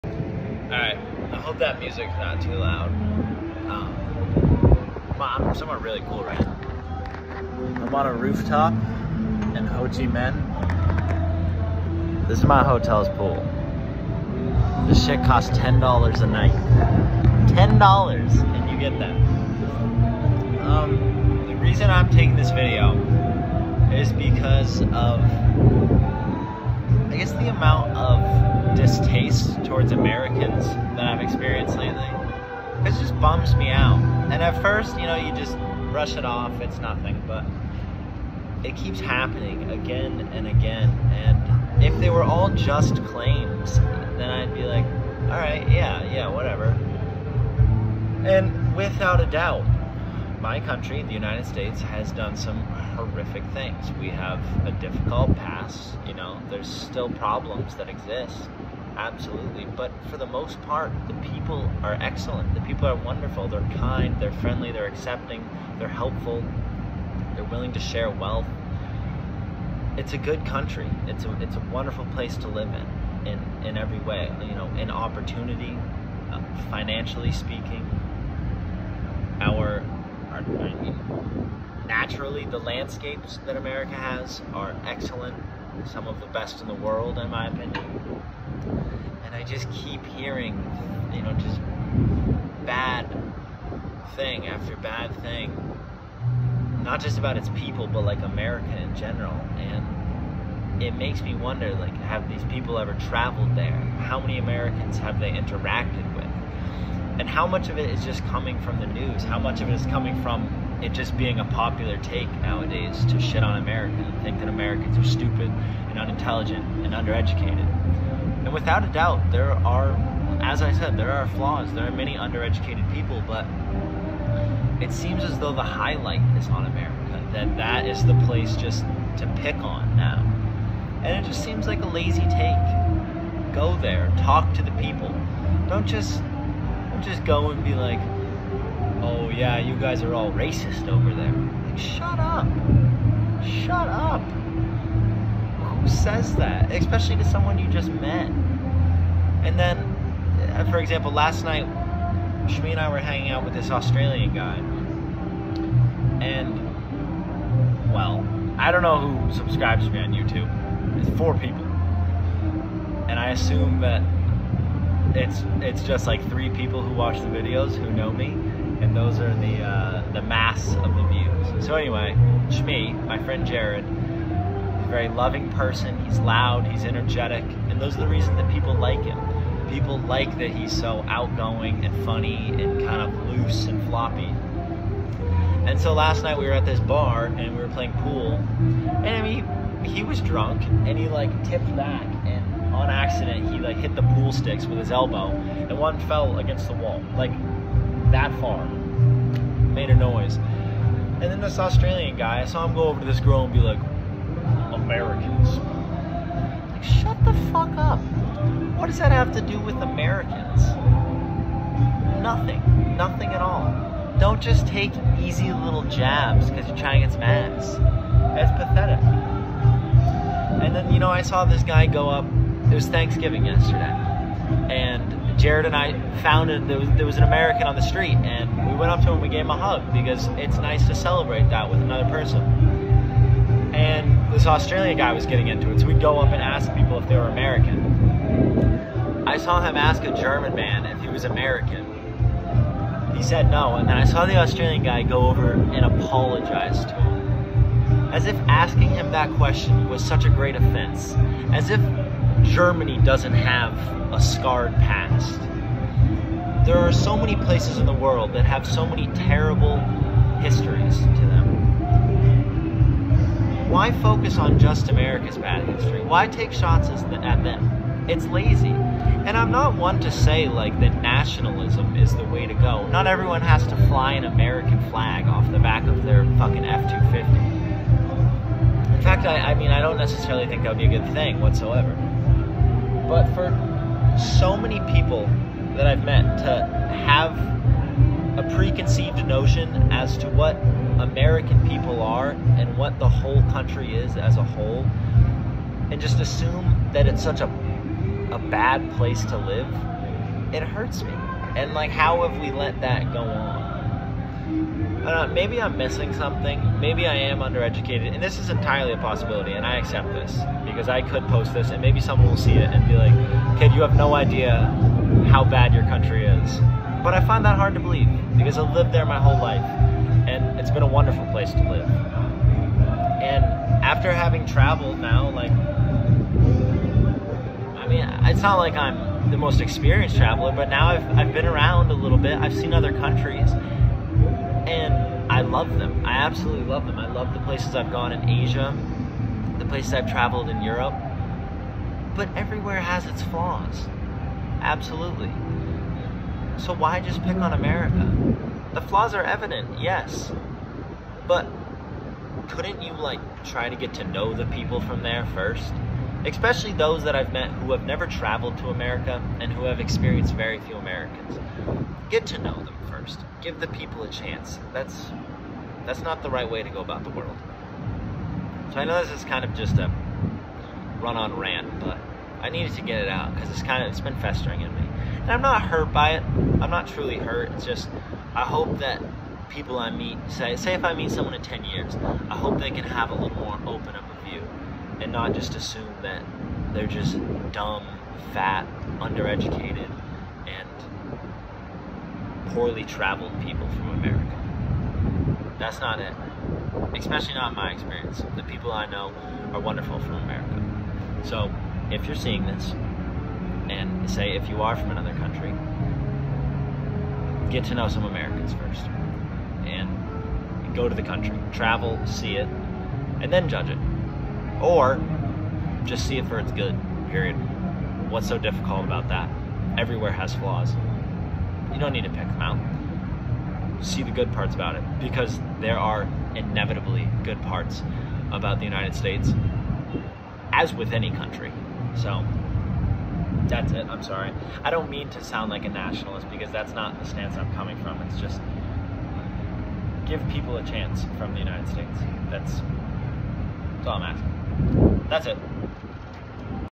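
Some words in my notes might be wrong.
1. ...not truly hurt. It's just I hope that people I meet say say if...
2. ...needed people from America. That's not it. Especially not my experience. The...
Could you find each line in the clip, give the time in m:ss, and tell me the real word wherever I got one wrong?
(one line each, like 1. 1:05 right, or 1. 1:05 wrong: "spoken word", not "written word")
1. 6:16 right
2. 6:32 wrong: "traveled", not "needed".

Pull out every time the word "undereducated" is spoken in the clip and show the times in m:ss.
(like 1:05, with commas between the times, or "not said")
1:56, 2:02, 5:07, 6:28.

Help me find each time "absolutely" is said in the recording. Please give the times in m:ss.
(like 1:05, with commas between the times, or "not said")
0:58, 5:36, 5:44.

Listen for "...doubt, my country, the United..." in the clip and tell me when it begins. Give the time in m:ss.
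0:49.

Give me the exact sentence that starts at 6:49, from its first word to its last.
And go to the country, travel, see it, and then judge it or just see it for its good, period.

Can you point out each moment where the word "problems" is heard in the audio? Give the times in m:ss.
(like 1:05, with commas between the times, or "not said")
0:57.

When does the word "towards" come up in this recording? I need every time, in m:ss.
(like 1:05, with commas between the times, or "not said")
0:29.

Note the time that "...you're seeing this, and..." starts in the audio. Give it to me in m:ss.
6:42.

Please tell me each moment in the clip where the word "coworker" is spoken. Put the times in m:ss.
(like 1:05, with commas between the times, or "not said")
not said.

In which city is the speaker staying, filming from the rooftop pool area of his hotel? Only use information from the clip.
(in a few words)
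Ho Chi Minh.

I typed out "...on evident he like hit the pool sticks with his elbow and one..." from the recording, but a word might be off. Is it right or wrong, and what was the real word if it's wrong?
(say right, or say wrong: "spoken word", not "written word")
wrong: "accident", not "evident".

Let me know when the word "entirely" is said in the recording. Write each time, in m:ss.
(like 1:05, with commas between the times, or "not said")
5:08.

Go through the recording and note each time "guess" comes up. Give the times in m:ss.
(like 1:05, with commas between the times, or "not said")
0:27.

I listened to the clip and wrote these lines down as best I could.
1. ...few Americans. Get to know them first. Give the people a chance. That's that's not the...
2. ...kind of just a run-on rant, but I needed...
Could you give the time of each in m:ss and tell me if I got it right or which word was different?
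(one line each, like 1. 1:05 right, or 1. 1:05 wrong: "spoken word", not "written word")
1. 6:00 right
2. 6:09 right.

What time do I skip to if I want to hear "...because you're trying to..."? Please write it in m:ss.
3:36.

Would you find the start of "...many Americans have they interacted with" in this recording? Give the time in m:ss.
1:44.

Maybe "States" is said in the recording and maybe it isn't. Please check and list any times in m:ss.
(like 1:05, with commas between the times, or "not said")
0:51, 7:08, 7:21.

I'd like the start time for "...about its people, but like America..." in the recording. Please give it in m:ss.
1:37.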